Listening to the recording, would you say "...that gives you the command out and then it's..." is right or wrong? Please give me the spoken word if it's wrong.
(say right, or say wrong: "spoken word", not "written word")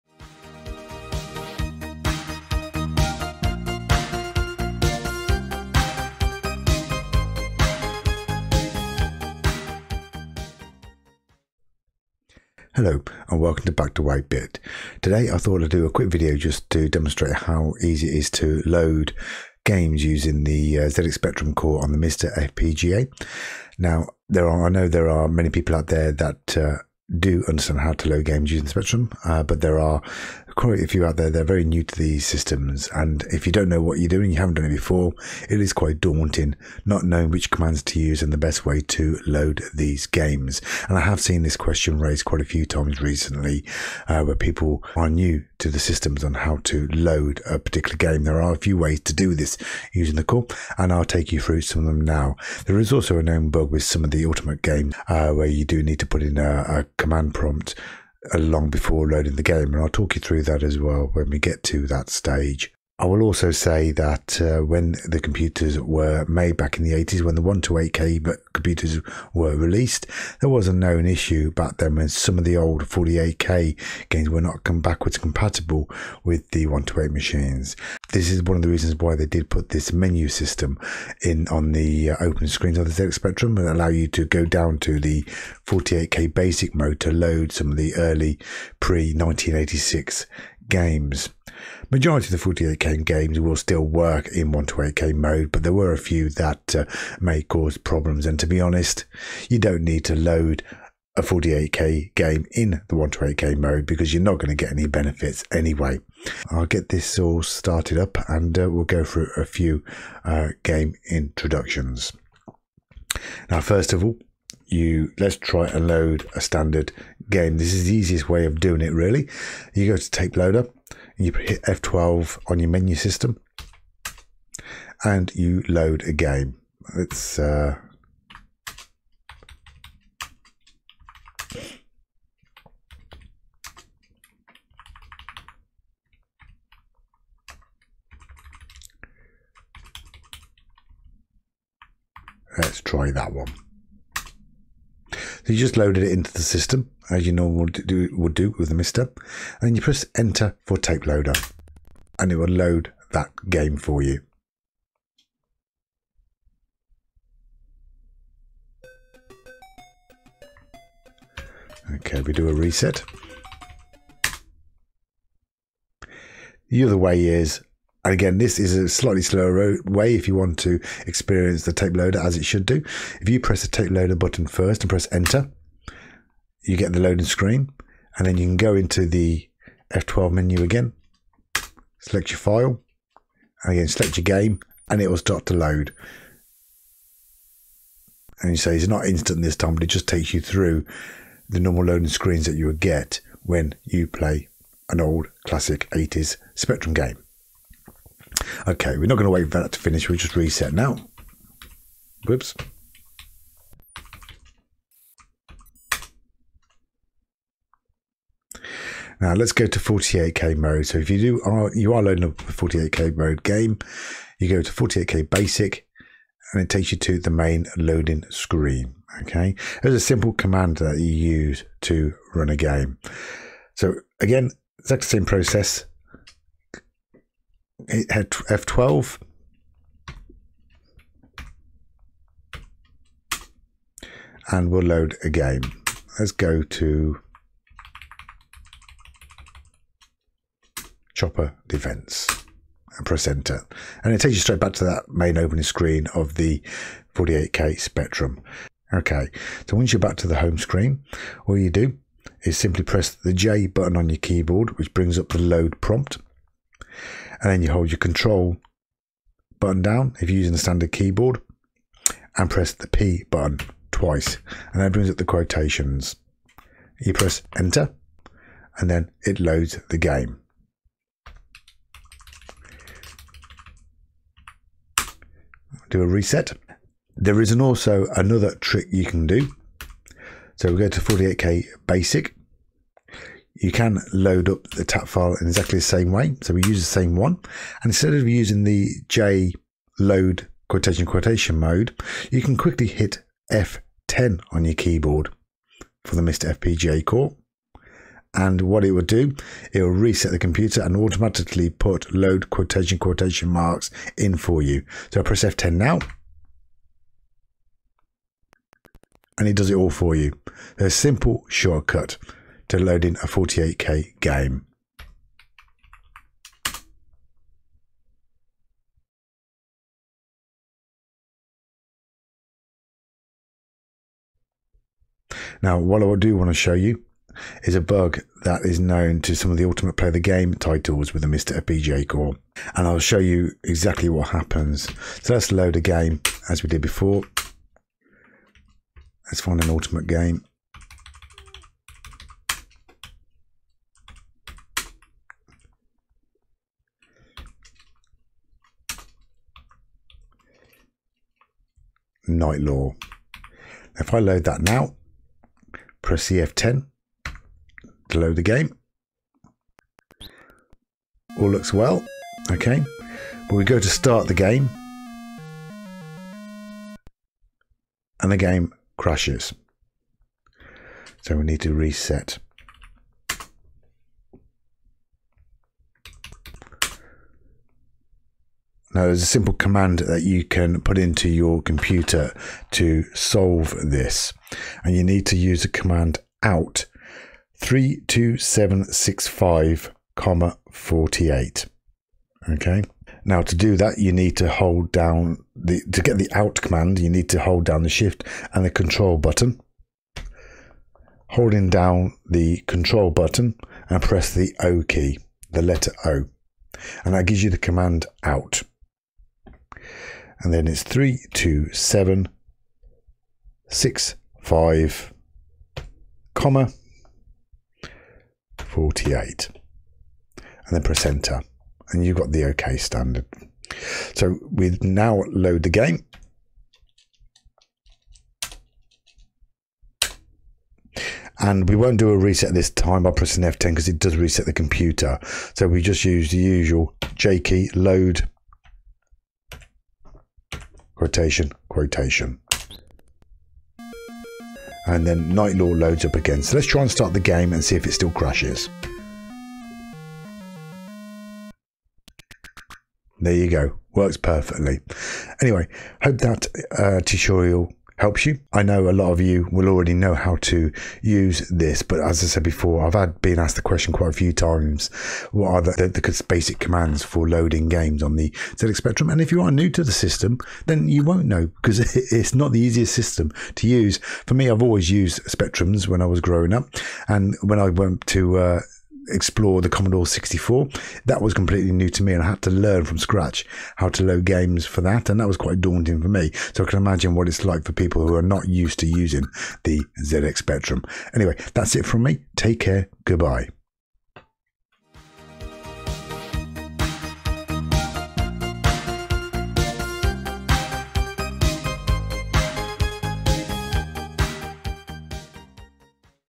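right.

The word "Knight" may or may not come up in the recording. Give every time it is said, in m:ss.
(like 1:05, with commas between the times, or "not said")
5:52, 7:25.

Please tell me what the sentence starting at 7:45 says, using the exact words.
What are the, the, the basic commands for loading games on the ZX Spectrum?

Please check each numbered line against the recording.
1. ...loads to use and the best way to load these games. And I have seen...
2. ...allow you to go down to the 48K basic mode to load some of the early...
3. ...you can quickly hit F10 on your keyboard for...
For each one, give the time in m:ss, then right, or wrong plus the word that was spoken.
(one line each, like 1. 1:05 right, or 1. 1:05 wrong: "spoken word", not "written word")
1. 0:37 wrong: "commands", not "loads"
2. 1:23 right
3. 4:52 right.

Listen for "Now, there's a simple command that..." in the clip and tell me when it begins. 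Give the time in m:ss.
6:18.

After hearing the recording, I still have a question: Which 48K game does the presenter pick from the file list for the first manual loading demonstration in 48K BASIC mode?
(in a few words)
Chopper Defense.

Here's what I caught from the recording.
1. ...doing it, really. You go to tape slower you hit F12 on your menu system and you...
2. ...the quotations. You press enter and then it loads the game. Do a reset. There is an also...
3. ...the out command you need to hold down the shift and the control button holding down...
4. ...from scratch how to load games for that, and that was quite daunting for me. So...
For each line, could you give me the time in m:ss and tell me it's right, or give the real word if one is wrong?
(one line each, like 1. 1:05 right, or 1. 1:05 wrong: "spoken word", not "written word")
1. 1:58 wrong: "loader", not "slower"
2. 4:25 right
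3. 6:36 right
4. 8:02 right.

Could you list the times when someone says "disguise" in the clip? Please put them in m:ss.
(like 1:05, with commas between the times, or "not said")
not said.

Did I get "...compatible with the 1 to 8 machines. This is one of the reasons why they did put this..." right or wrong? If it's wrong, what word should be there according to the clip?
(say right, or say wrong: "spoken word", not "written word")
right.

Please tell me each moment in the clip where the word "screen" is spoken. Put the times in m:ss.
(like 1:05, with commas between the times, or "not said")
1:22, 2:57, 3:12, 3:38, 4:05, 4:10.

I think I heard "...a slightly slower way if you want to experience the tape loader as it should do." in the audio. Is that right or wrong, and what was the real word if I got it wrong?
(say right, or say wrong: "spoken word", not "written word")
right.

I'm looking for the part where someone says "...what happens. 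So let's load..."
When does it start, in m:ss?
5:34.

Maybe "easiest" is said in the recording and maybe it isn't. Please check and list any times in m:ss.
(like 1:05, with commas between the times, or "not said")
1:57, 7:52.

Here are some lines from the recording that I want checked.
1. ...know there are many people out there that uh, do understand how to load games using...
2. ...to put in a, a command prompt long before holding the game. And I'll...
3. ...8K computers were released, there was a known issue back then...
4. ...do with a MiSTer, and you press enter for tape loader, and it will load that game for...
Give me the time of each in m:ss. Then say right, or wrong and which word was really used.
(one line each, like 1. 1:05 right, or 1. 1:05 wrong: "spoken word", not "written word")
1. 0:24 right
2. 0:55 wrong: "loading", not "holding"
3. 1:07 right
4. 2:28 right.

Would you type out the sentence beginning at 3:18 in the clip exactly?
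Okay, we're not going to wait for that to finish.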